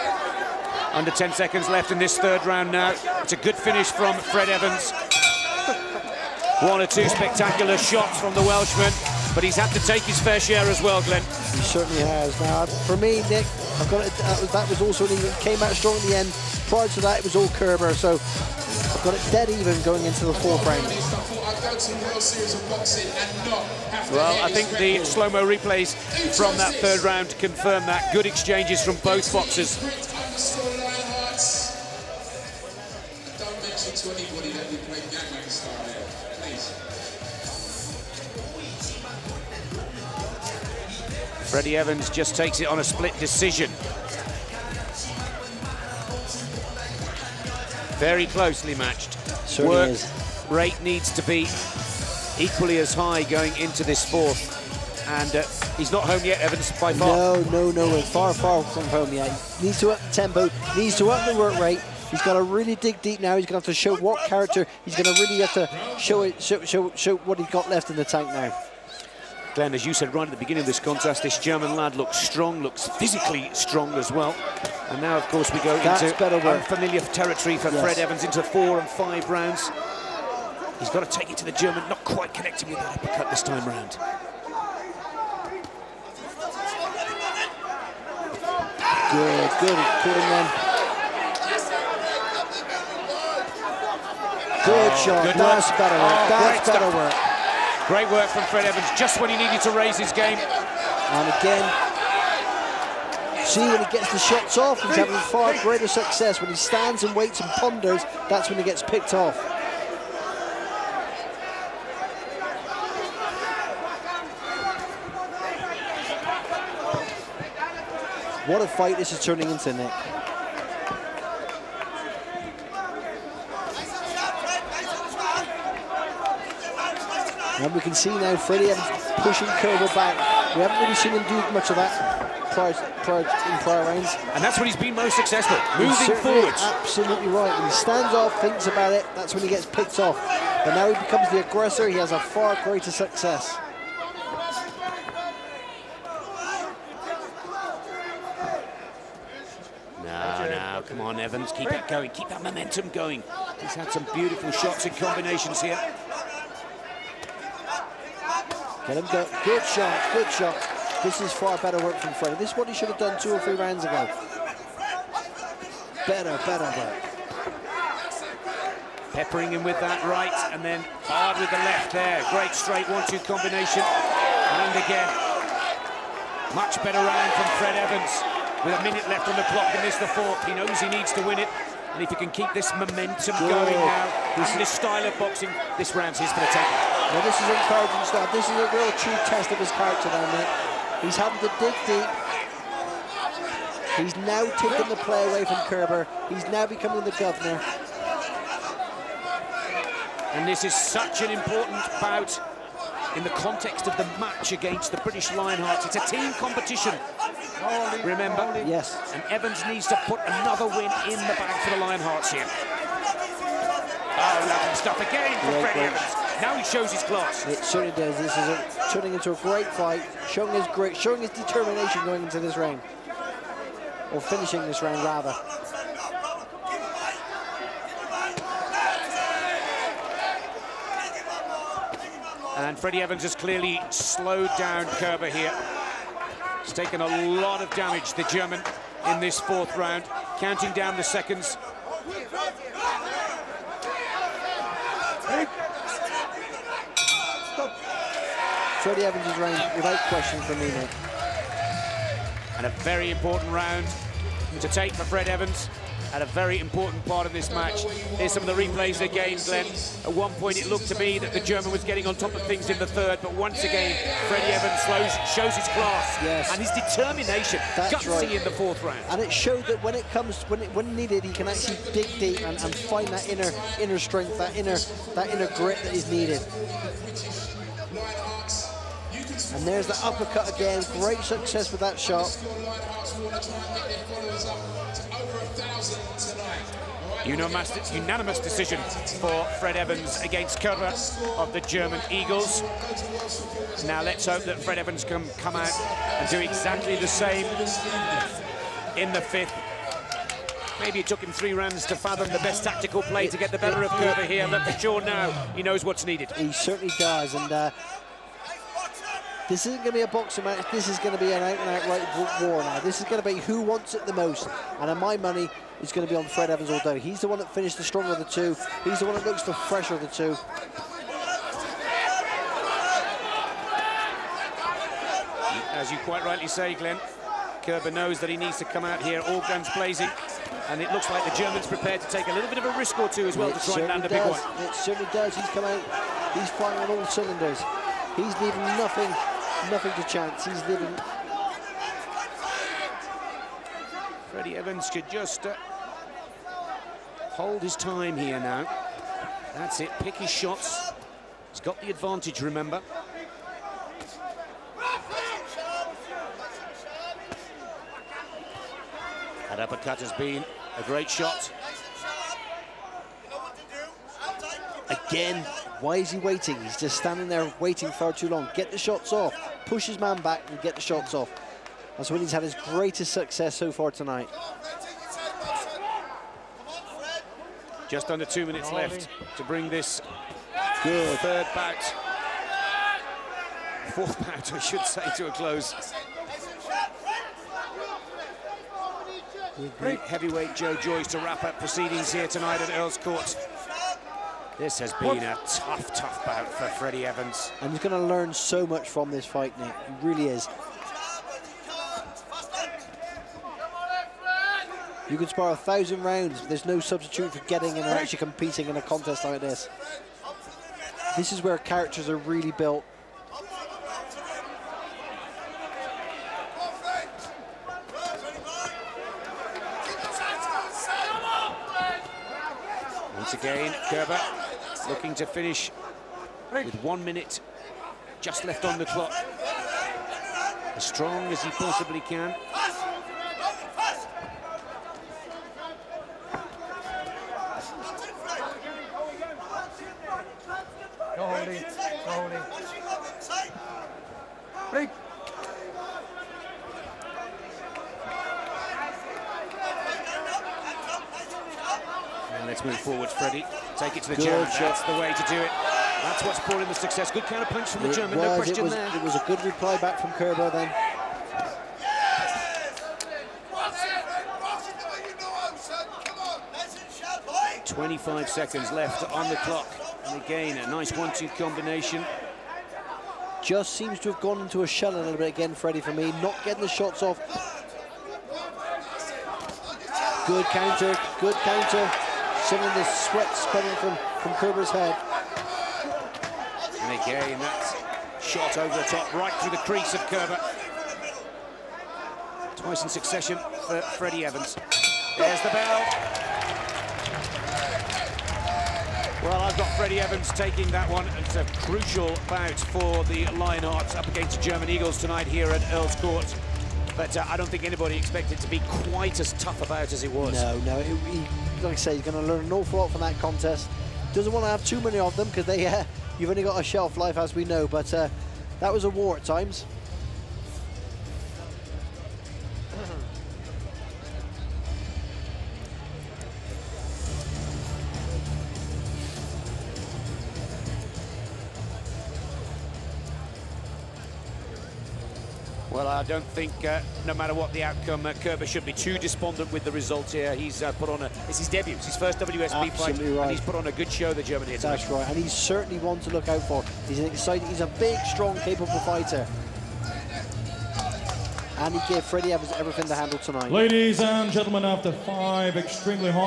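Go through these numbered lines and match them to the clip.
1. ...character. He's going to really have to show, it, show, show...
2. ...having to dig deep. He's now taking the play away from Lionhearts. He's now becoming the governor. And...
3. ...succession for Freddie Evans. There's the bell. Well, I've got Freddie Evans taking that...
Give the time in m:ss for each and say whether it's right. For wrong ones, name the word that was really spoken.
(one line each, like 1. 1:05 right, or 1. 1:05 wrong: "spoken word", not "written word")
1. 1:04 right
2. 3:11 wrong: "Kerber", not "Lionhearts"
3. 8:12 right.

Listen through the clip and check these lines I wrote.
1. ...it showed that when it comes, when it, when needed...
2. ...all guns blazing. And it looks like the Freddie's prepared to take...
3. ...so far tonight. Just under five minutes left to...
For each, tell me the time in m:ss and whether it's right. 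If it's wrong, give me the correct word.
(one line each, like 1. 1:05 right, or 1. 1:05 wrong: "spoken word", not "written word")
1. 4:29 right
2. 5:29 wrong: "German", not "Freddie"
3. 6:13 wrong: "two", not "five".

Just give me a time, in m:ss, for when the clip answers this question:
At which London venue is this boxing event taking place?
6:32.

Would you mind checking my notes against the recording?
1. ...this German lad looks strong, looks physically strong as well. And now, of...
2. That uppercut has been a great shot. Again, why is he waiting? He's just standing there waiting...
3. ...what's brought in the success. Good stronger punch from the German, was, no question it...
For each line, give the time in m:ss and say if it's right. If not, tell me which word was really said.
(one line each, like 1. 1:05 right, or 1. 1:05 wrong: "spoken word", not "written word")
1. 1:11 right
2. 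5:59 right
3. 7:36 wrong: "counter", not "stronger".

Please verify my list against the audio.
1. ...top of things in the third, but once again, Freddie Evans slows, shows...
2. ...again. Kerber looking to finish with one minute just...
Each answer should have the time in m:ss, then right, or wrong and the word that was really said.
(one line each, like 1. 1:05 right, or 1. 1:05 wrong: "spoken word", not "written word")
1. 4:22 right
2. 7:03 right.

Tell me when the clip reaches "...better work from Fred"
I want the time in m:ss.
2:41.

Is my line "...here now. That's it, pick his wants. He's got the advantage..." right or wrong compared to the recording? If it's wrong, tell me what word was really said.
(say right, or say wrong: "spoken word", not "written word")
wrong: "shots", not "wants".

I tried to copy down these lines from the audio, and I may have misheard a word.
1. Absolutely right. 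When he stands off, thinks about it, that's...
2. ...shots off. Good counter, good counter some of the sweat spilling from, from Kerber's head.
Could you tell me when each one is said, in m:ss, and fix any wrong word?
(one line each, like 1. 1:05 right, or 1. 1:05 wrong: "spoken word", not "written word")
1. 2:16 right
2. 7:56 right.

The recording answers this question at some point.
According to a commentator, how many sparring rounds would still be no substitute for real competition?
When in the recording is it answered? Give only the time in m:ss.
6:45.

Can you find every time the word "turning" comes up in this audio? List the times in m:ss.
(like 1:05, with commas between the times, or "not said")
1:59, 3:38.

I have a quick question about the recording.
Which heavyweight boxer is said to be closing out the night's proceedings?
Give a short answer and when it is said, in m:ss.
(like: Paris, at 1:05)
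Joe Joyce, at 6:30.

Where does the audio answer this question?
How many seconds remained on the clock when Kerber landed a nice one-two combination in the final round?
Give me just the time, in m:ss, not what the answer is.
7:47.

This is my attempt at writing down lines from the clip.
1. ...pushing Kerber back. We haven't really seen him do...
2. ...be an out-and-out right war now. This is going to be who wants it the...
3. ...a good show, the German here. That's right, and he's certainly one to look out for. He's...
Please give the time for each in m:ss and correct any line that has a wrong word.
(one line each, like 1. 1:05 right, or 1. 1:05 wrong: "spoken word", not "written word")
1. 2:09 right
2. 5:11 right
3. 9:03 right.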